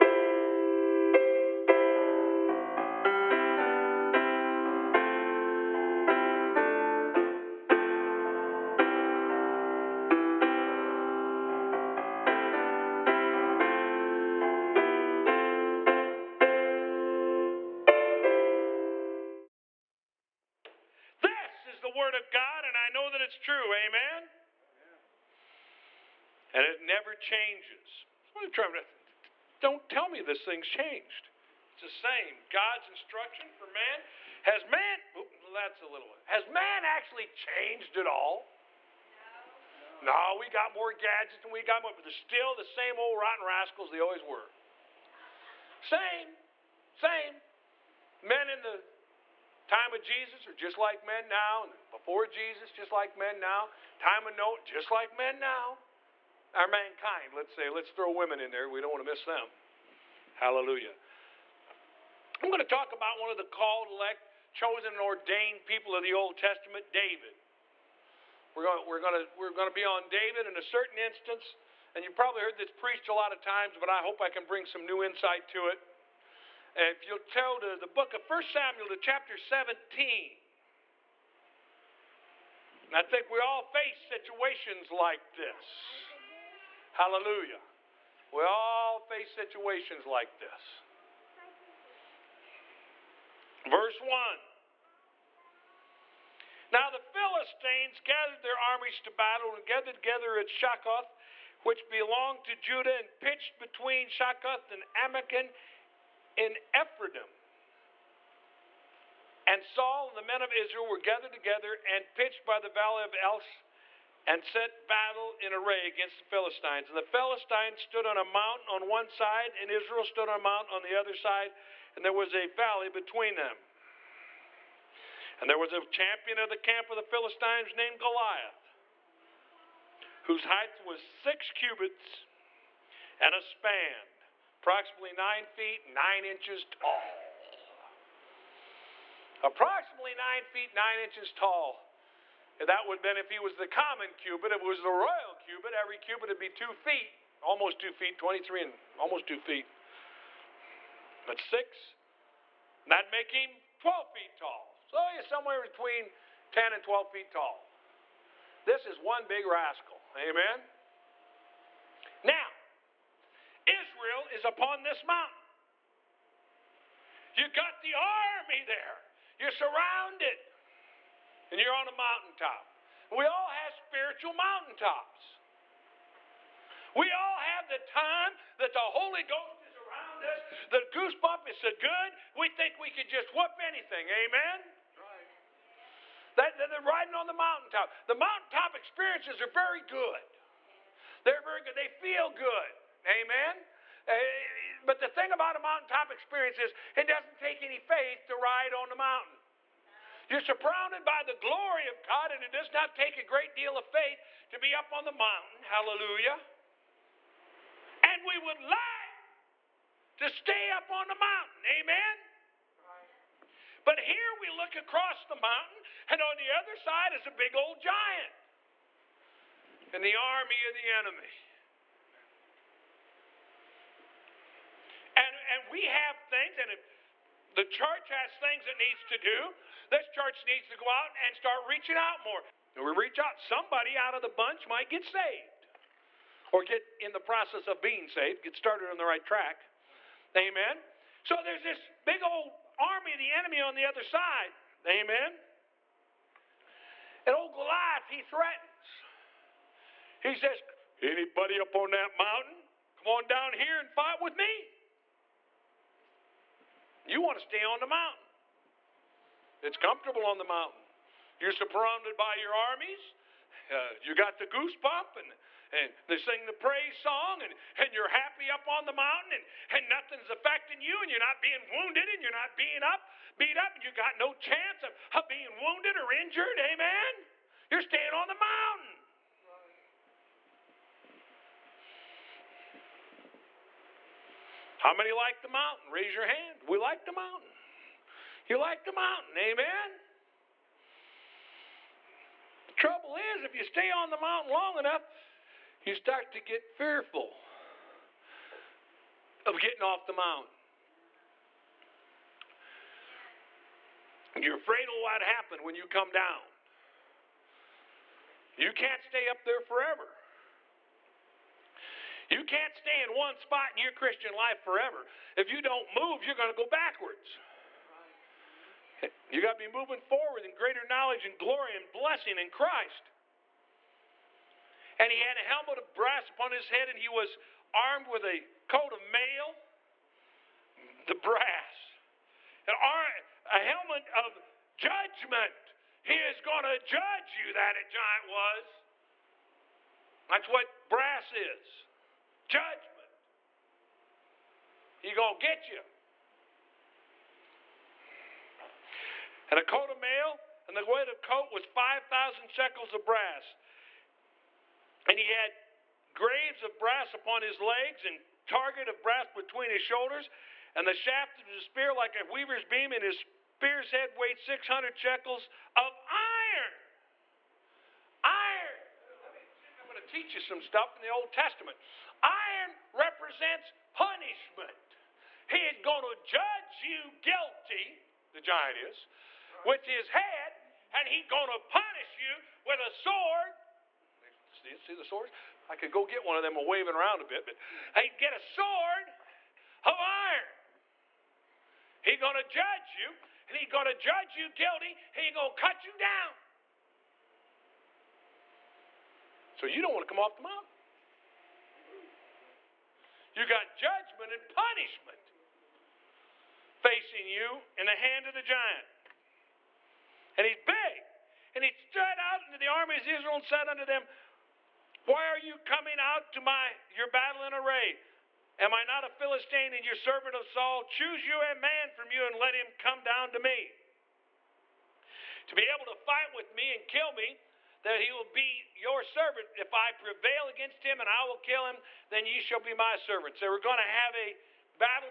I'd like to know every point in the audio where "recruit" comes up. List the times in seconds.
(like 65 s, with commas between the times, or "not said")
not said.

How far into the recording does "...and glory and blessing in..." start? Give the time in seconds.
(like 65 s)
321 s.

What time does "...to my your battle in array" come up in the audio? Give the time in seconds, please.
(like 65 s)
416 s.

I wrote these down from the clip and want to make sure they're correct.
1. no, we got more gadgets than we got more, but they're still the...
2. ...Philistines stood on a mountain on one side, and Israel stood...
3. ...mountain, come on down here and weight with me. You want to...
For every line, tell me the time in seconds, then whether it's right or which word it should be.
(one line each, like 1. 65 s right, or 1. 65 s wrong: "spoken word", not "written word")
1. 40 s right
2. 117 s right
3. 252 s wrong: "fight", not "weight".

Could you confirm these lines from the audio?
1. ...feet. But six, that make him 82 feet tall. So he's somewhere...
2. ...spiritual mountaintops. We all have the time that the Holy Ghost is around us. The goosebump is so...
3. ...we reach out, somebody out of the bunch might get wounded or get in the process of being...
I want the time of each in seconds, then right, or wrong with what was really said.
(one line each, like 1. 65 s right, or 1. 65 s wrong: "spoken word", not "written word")
1. 149 s wrong: "12", not "82"
2. 173 s right
3. 232 s wrong: "saved", not "wounded".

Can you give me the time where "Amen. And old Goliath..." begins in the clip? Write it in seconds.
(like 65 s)
244 s.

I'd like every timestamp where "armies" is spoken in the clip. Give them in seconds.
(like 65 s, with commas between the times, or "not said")
98 s, 262 s, 412 s.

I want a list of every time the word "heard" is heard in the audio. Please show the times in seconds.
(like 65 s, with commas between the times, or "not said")
72 s.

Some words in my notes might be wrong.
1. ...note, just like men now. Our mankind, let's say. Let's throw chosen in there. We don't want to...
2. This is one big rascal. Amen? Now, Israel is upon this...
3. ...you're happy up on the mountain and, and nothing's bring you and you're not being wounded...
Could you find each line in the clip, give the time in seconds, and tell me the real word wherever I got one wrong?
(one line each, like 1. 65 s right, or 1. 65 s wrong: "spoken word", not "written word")
1. 54 s wrong: "women", not "chosen"
2. 158 s right
3. 267 s wrong: "affecting", not "bring".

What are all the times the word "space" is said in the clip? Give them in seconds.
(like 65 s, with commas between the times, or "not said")
not said.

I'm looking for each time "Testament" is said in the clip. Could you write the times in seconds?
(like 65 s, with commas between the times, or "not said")
66 s, 371 s.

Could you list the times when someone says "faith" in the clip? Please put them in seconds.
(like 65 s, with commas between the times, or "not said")
197 s, 203 s.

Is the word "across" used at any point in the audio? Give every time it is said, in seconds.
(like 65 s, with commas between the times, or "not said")
214 s.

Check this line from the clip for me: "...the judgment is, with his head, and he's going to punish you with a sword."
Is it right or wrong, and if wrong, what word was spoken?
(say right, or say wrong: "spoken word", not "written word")
wrong: "giant", not "judgment".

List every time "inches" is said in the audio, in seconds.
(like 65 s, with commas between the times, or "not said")
136 s, 140 s.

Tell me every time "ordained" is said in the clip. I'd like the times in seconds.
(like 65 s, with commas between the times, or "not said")
65 s.